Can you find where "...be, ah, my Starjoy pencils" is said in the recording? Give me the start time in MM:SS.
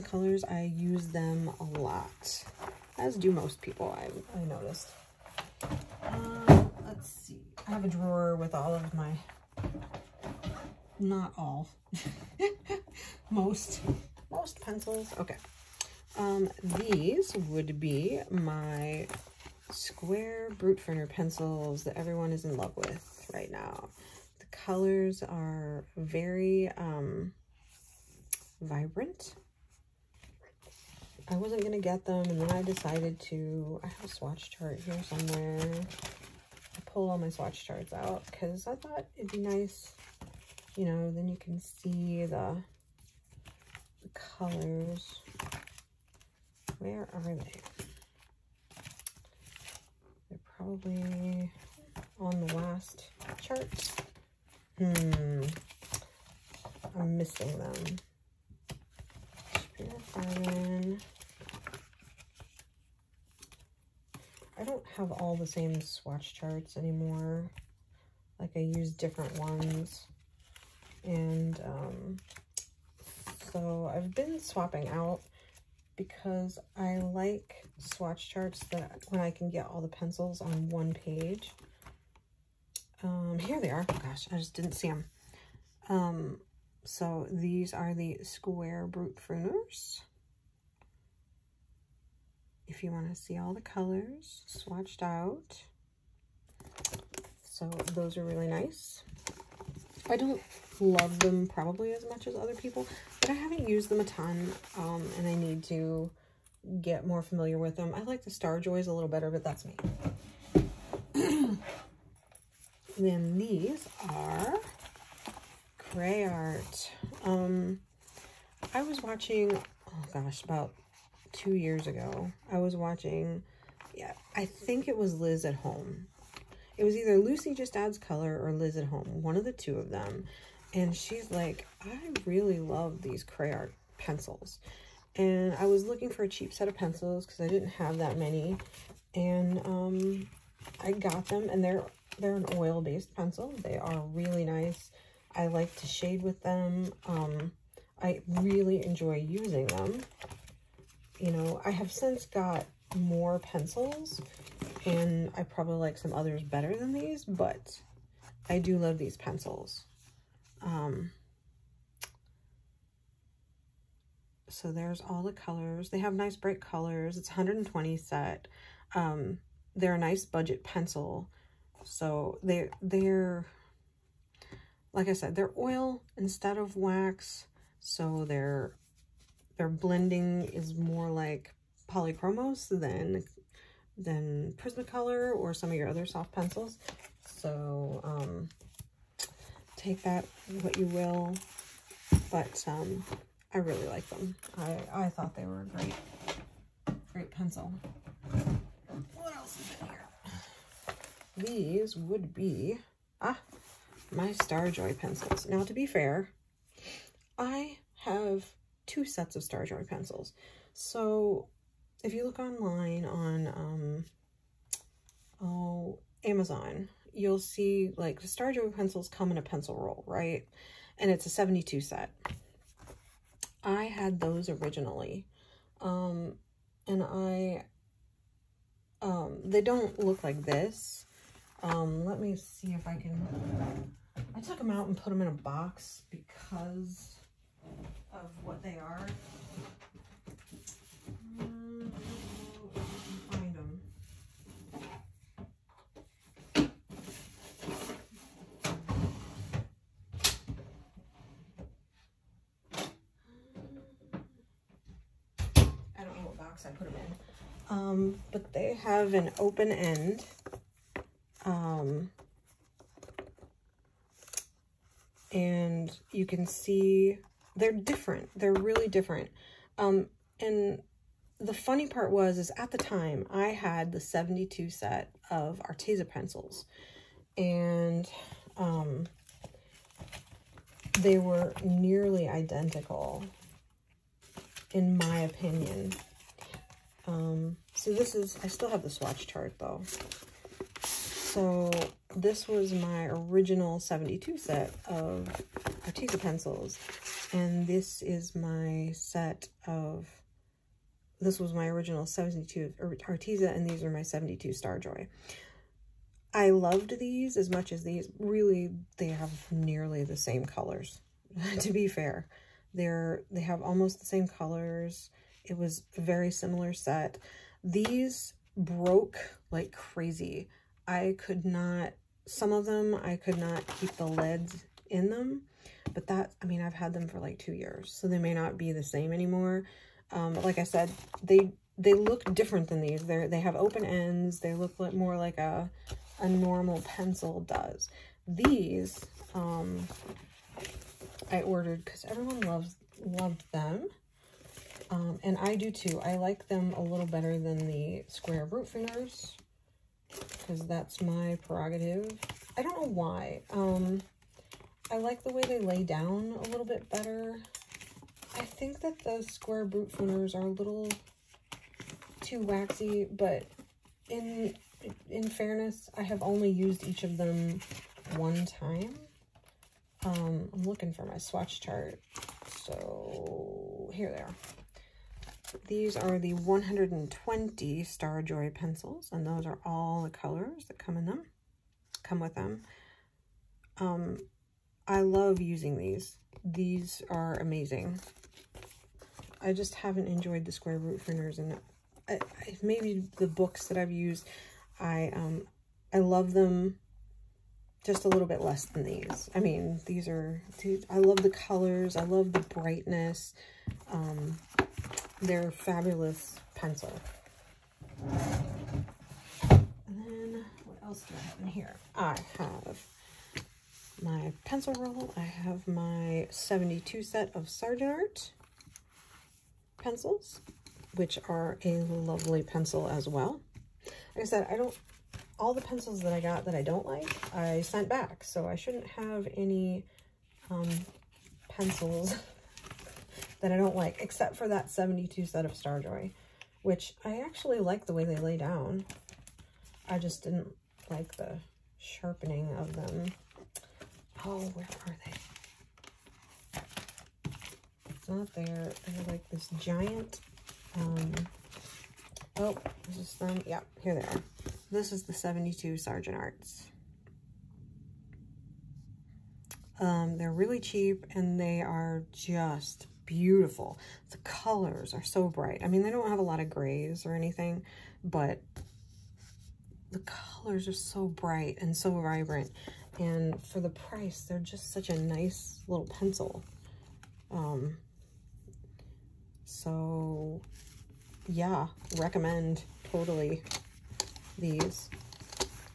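03:22.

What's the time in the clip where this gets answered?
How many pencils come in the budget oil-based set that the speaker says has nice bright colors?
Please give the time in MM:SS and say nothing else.
02:47.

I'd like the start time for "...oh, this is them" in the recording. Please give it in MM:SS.
07:32.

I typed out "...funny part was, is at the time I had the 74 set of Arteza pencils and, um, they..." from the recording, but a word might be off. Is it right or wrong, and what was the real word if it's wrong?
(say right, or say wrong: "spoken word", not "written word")
wrong: "72", not "74".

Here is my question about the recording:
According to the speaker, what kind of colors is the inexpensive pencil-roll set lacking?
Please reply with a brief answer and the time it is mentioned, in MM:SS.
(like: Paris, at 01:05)
Grays, at 07:46.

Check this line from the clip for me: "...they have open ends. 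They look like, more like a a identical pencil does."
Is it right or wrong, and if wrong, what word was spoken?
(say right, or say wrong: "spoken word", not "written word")
wrong: "normal", not "identical".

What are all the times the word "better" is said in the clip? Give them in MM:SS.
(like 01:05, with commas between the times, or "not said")
01:49, 02:36, 05:47, 05:56.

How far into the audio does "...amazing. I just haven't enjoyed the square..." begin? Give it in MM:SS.
06:27.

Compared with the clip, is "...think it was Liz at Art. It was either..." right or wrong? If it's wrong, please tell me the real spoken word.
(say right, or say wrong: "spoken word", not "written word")
wrong: "Home", not "Art".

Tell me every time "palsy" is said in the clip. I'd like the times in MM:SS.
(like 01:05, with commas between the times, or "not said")
not said.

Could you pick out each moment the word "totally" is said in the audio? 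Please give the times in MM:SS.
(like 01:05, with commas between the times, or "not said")
08:02.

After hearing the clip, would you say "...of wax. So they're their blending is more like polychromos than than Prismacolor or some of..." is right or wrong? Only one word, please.
right.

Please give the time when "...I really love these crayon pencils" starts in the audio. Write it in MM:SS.
02:11.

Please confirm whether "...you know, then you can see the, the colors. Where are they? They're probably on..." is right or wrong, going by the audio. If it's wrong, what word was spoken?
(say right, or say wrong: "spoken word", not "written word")
right.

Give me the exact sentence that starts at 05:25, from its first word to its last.
But that, I mean, I've had them for like two years, so they may not be the same anymore.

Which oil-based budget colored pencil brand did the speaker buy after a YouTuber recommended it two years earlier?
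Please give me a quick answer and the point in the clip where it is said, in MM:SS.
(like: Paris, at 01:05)
Cray Art, at 01:55.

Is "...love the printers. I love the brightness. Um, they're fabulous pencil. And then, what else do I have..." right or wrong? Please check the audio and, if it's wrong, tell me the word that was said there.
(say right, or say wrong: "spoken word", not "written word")
wrong: "colors", not "printers".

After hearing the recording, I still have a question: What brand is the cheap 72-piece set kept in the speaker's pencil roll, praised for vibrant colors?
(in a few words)
Sargent Art.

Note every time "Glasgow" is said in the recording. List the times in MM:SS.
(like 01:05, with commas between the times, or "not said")
not said.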